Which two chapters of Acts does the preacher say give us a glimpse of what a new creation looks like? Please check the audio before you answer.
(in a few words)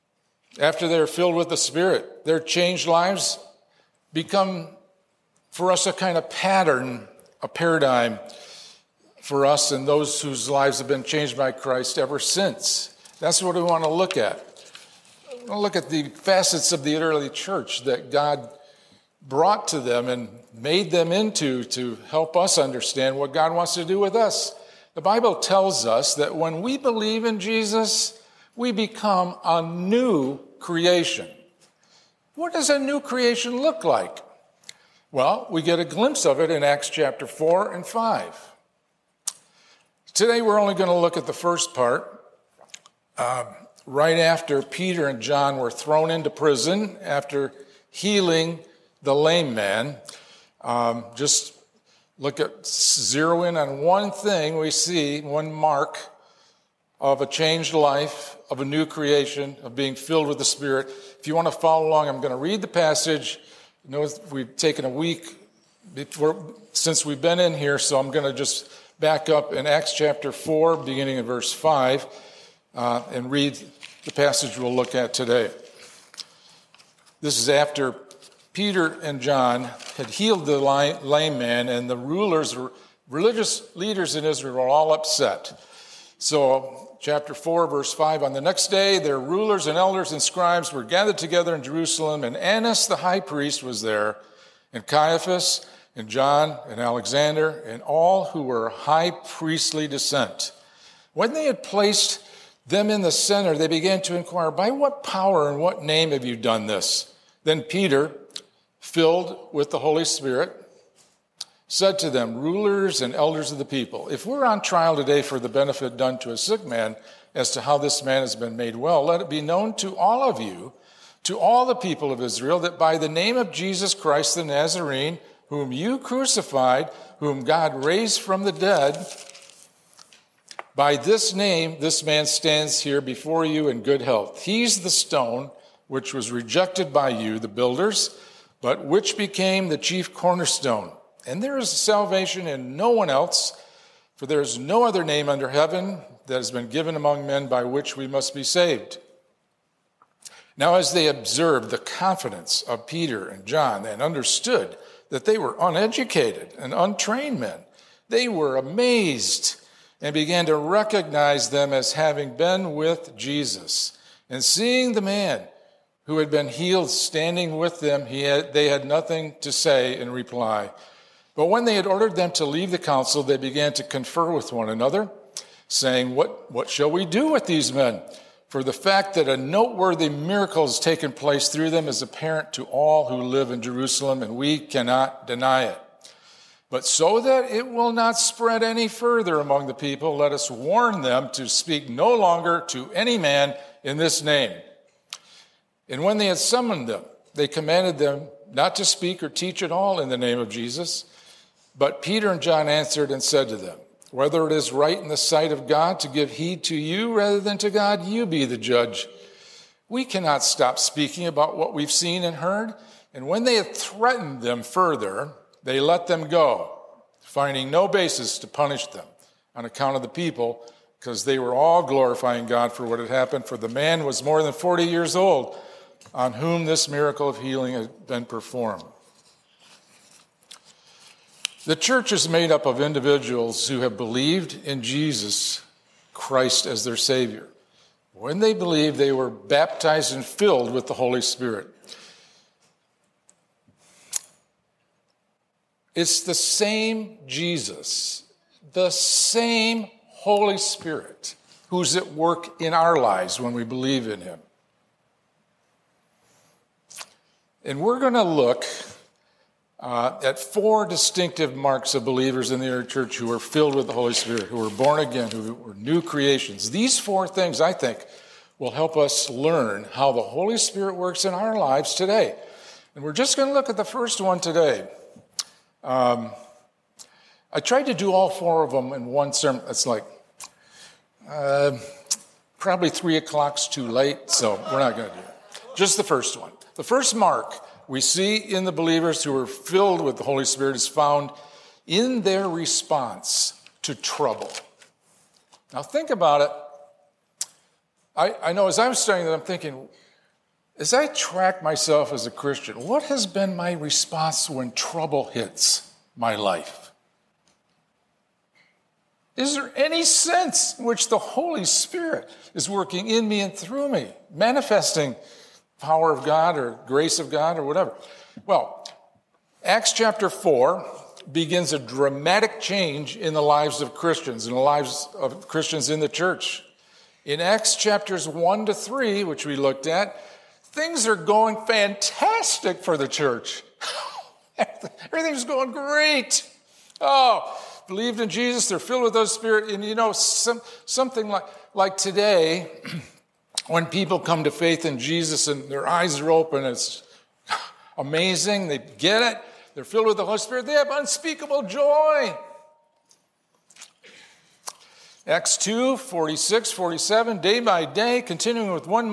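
Acts 4 and 5.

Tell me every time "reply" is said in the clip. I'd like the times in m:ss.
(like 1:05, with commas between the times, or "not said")
2:50.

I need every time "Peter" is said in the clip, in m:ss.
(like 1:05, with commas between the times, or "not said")
0:44, 1:18, 1:47, 2:32, 3:22.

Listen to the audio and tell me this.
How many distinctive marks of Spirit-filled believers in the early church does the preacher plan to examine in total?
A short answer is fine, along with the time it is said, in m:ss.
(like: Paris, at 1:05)
4, at 4:20.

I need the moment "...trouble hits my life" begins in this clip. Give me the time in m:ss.
5:04.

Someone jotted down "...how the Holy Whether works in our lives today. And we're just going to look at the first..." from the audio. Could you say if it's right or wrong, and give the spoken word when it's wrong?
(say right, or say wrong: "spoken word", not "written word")
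wrong: "Spirit", not "Whether".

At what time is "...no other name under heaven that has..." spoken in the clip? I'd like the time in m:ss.
2:24.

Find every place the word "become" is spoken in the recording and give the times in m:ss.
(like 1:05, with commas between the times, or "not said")
0:04, 0:28.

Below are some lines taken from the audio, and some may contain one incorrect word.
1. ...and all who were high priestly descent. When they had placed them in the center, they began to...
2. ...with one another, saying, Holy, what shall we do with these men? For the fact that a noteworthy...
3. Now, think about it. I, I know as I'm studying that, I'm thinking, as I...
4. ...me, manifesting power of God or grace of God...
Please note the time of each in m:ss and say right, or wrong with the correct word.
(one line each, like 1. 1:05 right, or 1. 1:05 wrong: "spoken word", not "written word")
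1. 1:37 right
2. 2:54 wrong: "What", not "Holy"
3. 4:55 right
4. 5:13 right.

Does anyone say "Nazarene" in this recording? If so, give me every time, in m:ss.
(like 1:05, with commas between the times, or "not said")
2:04.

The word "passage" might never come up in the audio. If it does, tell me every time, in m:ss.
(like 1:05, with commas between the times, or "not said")
1:02, 1:14.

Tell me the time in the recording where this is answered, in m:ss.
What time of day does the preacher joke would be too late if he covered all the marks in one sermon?
4:42.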